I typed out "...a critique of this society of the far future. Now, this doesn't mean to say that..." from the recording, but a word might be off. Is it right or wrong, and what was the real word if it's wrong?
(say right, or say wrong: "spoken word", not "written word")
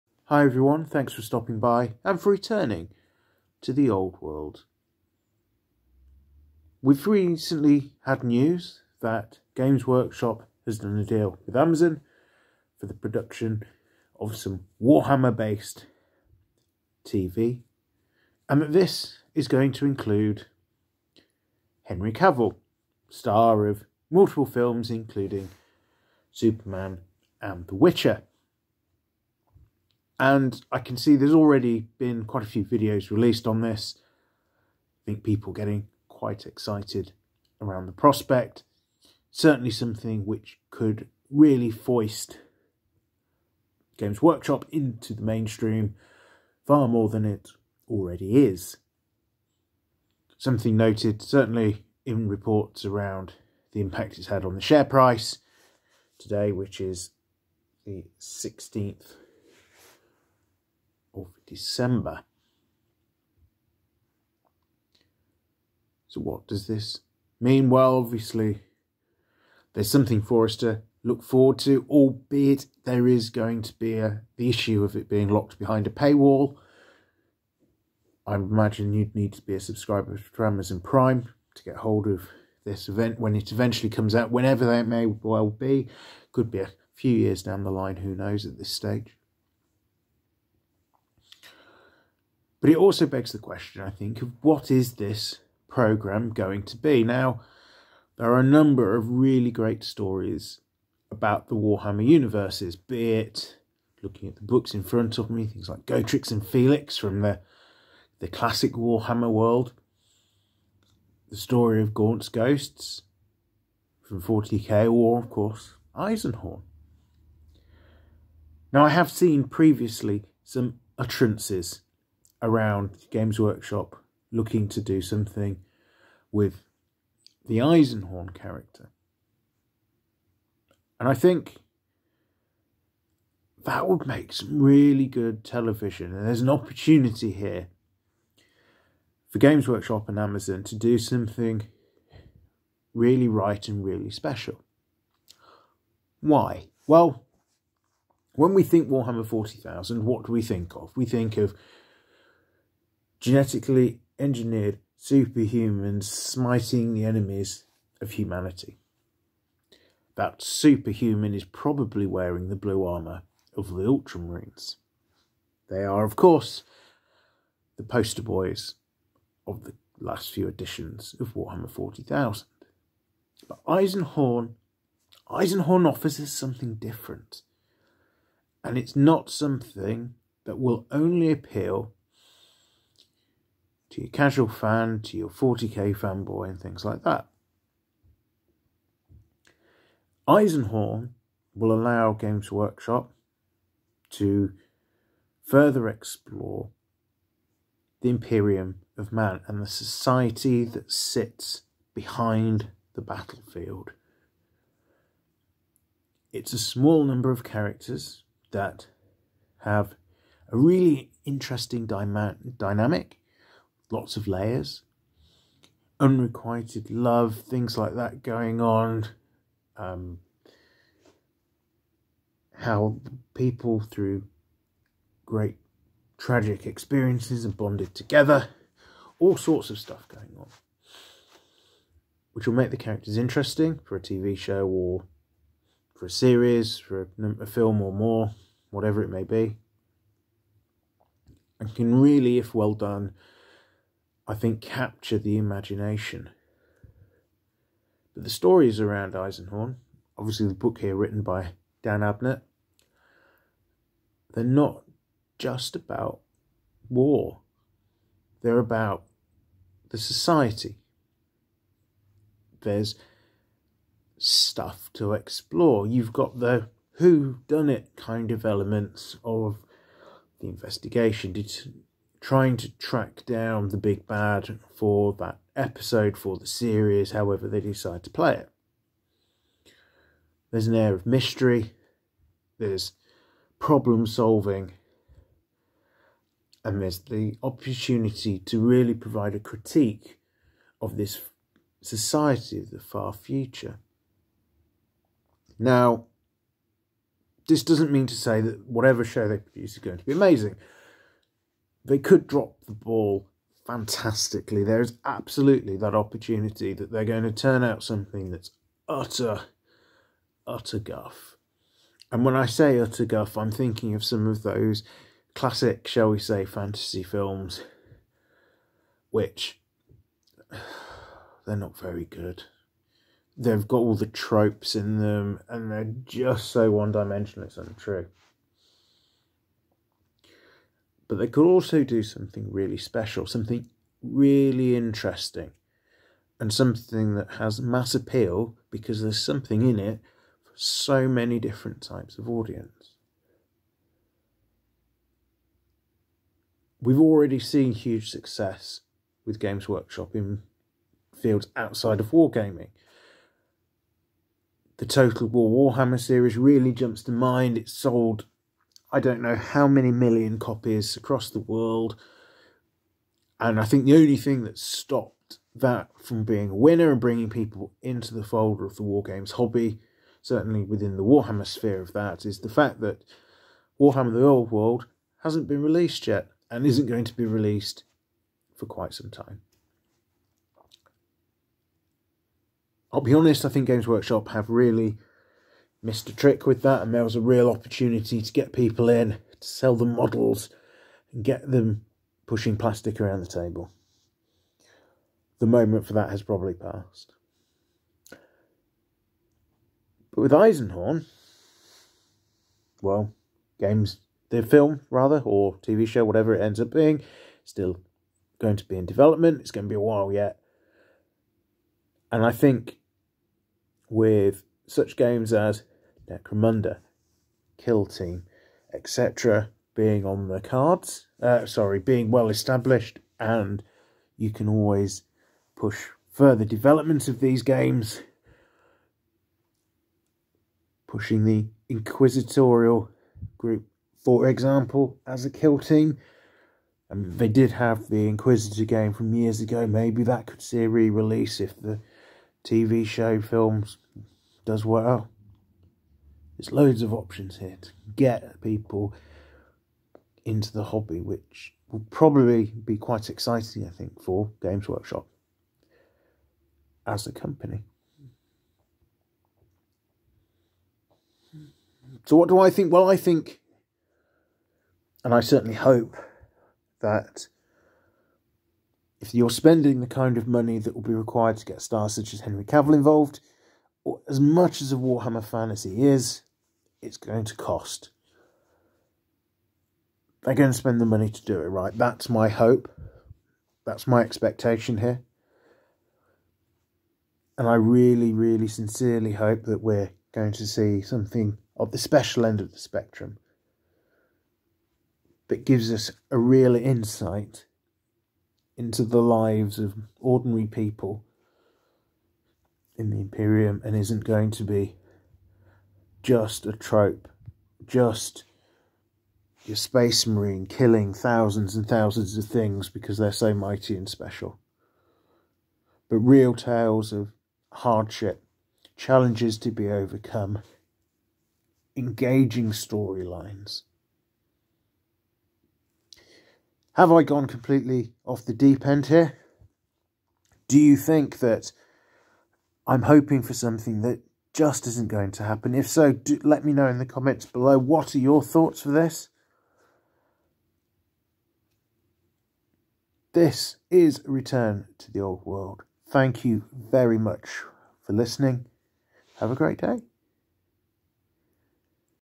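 right.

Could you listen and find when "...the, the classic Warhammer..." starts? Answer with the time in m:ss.
1:47.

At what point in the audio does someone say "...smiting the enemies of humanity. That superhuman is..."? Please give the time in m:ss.
2:36.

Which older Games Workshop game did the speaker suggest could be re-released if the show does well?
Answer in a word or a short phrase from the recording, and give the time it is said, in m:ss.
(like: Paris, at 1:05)
Inquisitor, at 7:18.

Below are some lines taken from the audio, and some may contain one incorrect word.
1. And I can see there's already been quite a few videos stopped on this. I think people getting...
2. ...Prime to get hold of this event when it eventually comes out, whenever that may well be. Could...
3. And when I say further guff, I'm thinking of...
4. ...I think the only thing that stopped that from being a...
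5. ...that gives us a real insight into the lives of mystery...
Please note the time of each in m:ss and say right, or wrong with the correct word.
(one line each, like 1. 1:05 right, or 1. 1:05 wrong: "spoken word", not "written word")
1. 0:30 wrong: "released", not "stopped"
2. 1:20 right
3. 5:12 wrong: "utter", not "further"
4. 6:03 right
5. 8:15 wrong: "ordinary", not "mystery".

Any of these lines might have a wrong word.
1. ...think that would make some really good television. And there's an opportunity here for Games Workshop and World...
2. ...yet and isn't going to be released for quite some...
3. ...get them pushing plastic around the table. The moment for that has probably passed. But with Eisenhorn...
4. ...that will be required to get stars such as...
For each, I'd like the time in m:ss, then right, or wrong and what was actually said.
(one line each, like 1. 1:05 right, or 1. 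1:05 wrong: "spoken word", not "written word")
1. 2:11 wrong: "Amazon", not "World"
2. 6:16 right
3. 6:31 right
4. 7:50 right.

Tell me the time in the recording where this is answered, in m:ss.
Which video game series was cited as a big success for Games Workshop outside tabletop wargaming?
5:54.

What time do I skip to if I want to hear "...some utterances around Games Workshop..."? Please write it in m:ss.
2:00.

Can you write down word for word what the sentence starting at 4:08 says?
But the stories around Eisenhorn, obviously the book here written by Dan Abnett, they're not just about war.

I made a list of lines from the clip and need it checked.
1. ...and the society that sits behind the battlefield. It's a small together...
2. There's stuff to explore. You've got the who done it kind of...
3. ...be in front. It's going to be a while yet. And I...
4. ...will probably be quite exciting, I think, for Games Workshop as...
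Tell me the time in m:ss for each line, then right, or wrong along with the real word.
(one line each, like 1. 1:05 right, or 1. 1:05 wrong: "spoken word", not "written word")
1. 3:19 wrong: "number", not "together"
2. 4:22 right
3. 6:48 wrong: "development", not "front"
4. 7:31 right.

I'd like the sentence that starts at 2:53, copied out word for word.
But Eisenhorn, Eisenhorn offers us something different.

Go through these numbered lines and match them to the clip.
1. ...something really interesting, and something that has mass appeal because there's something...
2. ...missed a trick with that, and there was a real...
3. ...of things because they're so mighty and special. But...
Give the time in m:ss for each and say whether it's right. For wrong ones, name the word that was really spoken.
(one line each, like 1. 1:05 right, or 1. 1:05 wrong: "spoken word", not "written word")
1. 5:33 right
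2. 6:25 right
3. 8:32 right.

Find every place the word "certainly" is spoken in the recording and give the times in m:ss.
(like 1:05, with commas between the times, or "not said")
0:39, 0:51, 6:10, 7:45.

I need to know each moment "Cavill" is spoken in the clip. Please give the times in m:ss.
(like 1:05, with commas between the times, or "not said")
0:22, 7:52.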